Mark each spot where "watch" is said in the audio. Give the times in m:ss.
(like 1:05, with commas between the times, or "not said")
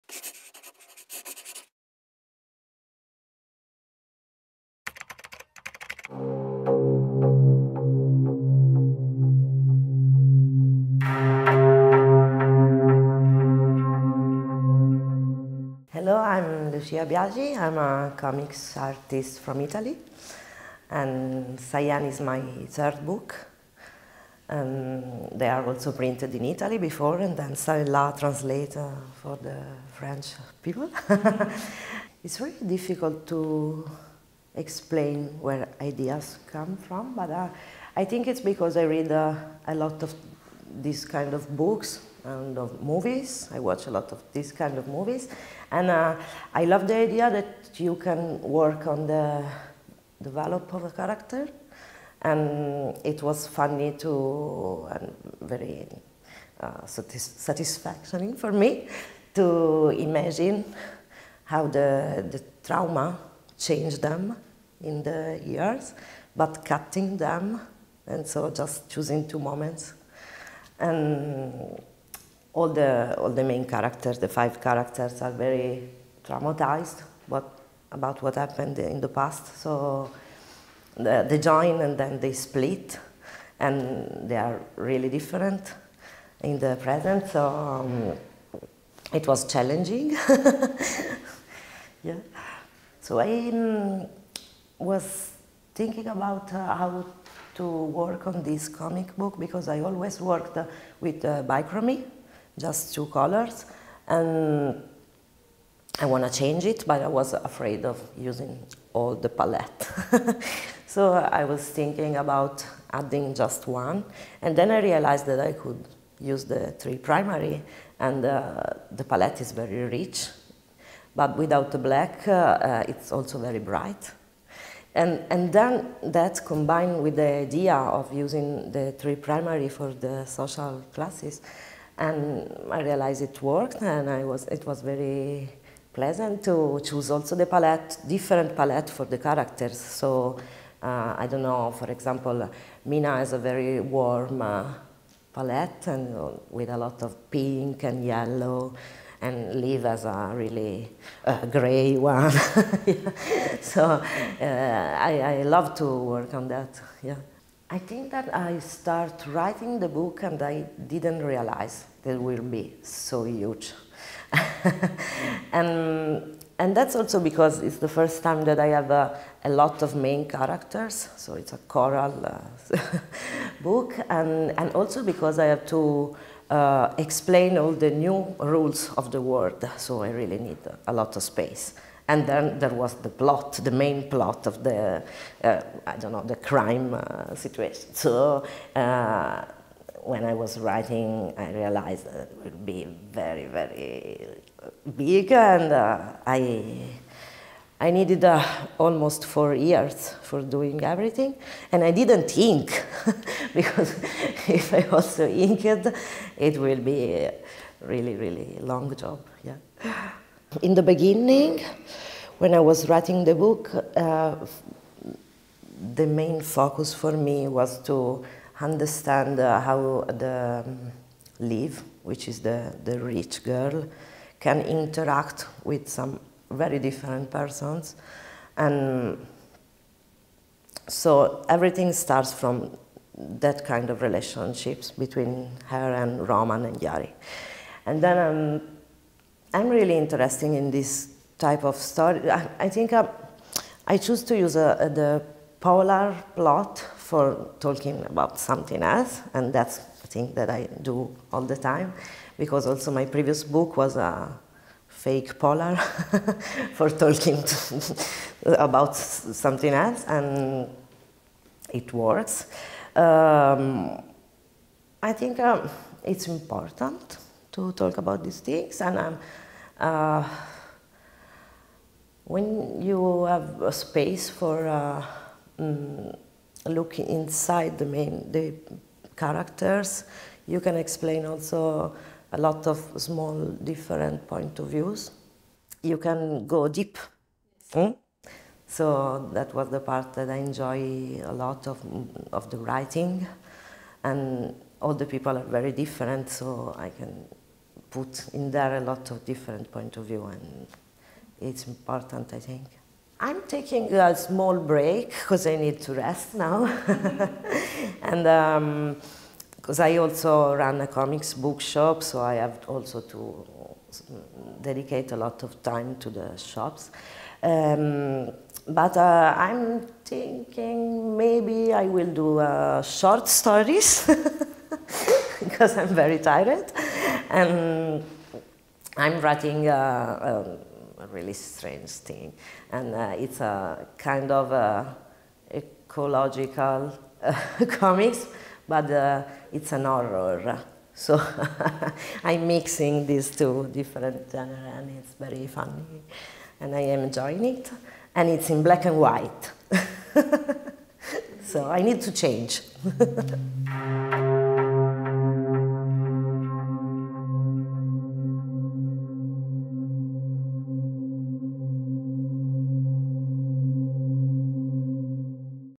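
0:43.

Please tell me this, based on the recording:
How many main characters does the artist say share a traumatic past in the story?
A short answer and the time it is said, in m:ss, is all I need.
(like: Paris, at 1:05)
5, at 1:14.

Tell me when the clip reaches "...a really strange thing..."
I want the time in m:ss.
5:30.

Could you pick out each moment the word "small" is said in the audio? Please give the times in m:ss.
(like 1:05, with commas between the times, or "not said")
4:42, 5:04.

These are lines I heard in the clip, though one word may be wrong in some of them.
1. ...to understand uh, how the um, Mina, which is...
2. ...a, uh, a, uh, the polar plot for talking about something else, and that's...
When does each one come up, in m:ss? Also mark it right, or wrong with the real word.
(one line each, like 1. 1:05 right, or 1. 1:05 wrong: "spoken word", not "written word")
1. 3:37 wrong: "Liv", not "Mina"
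2. 4:04 right.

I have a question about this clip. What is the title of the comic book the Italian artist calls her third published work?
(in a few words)
Cyan.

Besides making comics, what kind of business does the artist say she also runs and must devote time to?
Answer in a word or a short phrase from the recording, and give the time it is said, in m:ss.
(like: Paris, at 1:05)
a comics bookshop, at 5:10.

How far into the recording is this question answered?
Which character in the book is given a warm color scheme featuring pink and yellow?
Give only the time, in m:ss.
2:22.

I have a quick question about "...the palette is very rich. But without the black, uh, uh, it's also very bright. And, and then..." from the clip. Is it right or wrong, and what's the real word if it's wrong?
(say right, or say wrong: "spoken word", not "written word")
right.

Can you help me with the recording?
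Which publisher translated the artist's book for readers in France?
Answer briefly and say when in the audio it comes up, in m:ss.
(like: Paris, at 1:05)
Çà et là, at 0:27.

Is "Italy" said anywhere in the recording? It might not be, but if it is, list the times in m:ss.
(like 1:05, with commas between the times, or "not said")
0:19, 0:26.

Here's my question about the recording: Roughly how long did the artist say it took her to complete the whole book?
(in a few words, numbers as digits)
4 years.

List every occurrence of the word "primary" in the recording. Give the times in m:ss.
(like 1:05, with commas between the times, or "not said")
1:56, 2:09.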